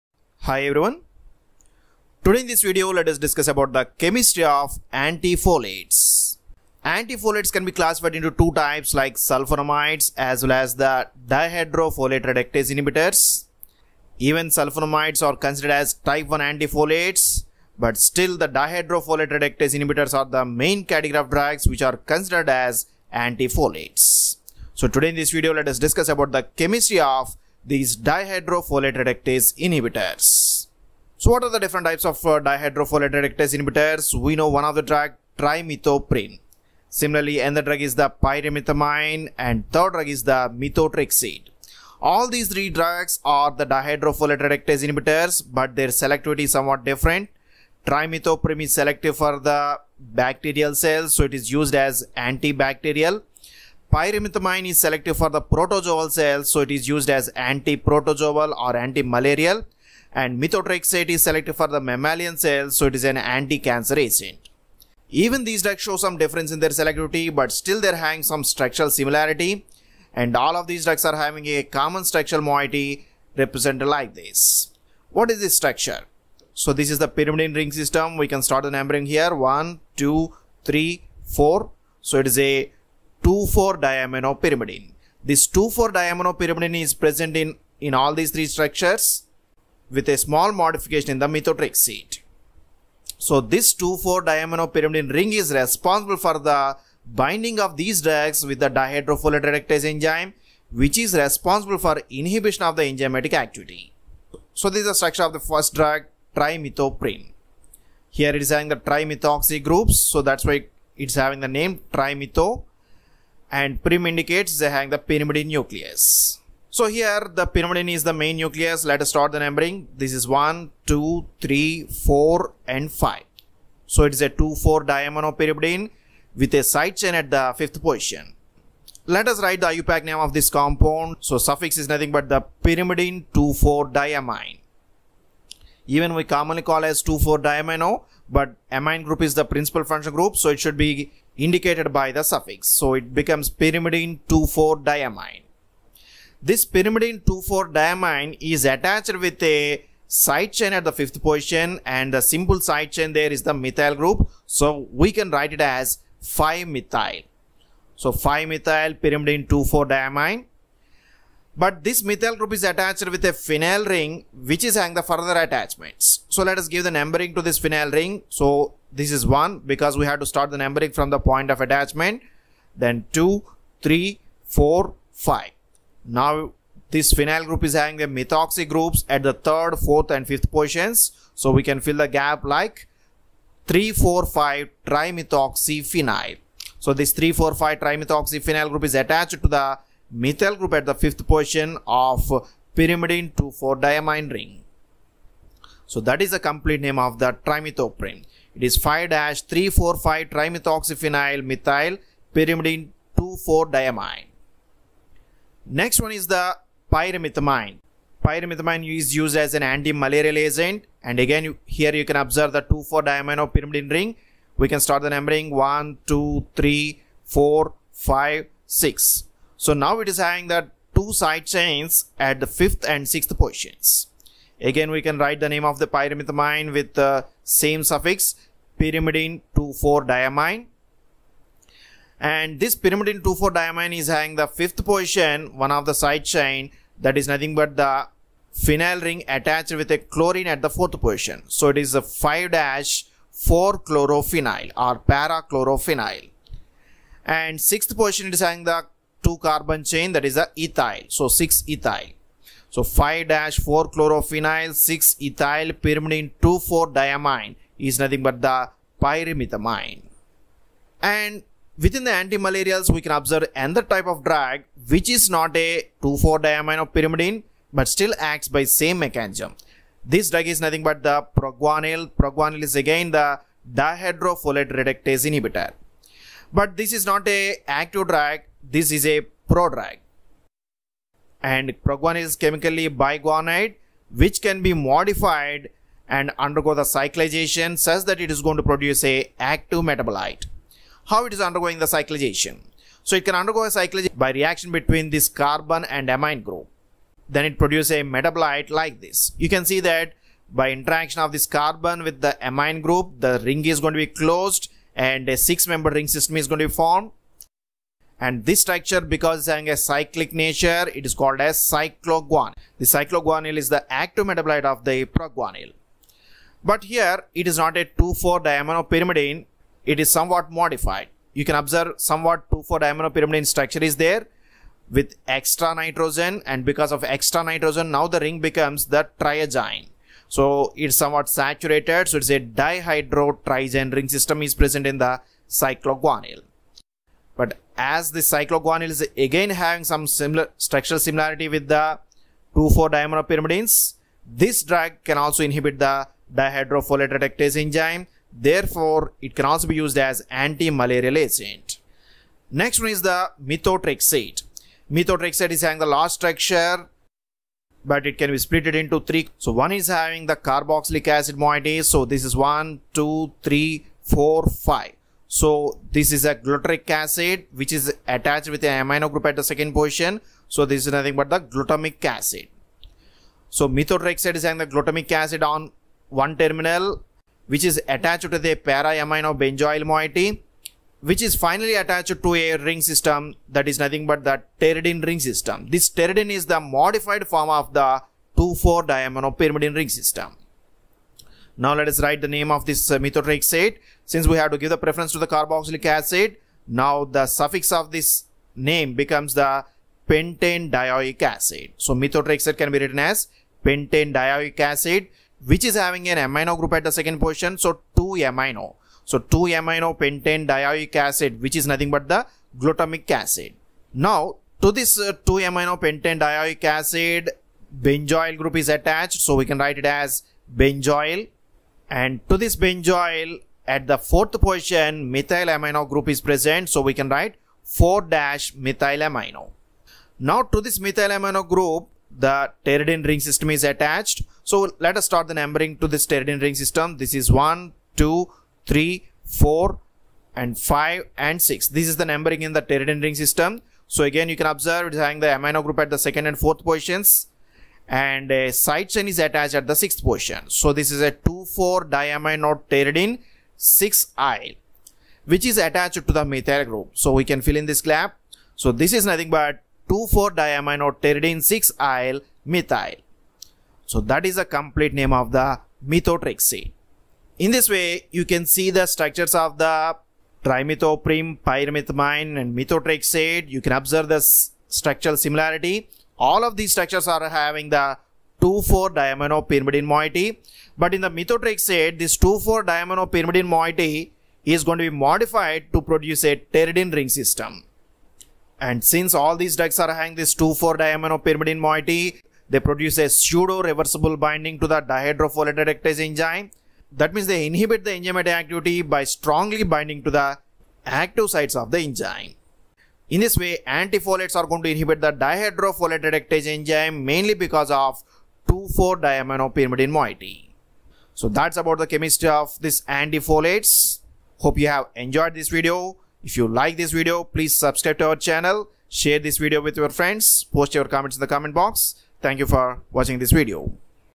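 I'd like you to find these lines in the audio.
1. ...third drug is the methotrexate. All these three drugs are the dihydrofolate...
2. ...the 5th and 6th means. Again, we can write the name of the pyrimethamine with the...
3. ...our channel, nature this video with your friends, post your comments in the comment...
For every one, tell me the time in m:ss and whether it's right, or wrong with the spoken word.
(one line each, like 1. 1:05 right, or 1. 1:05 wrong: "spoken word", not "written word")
1. 0:39 right
2. 3:42 wrong: "positions", not "means"
3. 8:38 wrong: "share", not "nature".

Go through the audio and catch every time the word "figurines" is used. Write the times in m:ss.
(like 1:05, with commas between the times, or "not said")
not said.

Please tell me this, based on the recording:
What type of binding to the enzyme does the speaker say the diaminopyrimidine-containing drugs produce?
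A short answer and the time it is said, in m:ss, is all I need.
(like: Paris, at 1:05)
pseudo reversible binding, at 8:13.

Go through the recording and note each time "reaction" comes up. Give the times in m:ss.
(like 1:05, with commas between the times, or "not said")
4:54.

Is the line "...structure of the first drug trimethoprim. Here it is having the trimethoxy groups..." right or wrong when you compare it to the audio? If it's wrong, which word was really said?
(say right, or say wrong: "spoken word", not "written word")
right.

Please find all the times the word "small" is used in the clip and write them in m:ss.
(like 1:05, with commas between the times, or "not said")
1:30.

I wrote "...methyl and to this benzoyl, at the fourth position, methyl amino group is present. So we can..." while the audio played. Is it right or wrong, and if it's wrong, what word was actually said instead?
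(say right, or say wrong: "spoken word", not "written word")
wrong: "benzoyl", not "methyl".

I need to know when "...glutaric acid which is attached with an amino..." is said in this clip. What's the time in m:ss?
6:06.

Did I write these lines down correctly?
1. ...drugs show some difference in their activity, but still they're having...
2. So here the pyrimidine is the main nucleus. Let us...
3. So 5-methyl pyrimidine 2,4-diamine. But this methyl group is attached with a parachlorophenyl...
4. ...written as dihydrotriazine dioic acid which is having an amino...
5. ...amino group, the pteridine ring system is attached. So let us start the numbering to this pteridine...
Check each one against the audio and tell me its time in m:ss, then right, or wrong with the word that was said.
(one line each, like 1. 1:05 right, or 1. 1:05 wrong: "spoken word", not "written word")
1. 1:05 wrong: "selectivity", not "activity"
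2. 1:56 right
3. 2:37 wrong: "phenyl", not "parachlorophenyl"
4. 6:42 wrong: "pentane", not "dihydrotriazine"
5. 7:11 right.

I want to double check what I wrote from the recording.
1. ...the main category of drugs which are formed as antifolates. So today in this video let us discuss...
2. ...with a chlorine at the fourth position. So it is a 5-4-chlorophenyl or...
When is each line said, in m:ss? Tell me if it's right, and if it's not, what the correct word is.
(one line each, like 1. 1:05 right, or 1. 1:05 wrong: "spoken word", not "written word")
1. 0:20 wrong: "considered", not "formed"
2. 3:59 right.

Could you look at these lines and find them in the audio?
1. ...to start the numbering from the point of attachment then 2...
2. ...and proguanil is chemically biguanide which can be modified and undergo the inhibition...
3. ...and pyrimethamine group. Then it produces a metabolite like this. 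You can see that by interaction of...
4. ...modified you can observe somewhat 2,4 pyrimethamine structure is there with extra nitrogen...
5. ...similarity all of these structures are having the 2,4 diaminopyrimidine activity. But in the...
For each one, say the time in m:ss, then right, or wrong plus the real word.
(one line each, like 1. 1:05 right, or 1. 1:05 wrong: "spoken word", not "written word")
1. 2:50 right
2. 4:41 wrong: "cyclization", not "inhibition"
3. 4:55 wrong: "amine", not "pyrimethamine"
4. 5:20 wrong: "diaminopyrimidine", not "pyrimethamine"
5. 7:55 wrong: "moiety", not "activity".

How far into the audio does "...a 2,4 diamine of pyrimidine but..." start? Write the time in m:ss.
4:25.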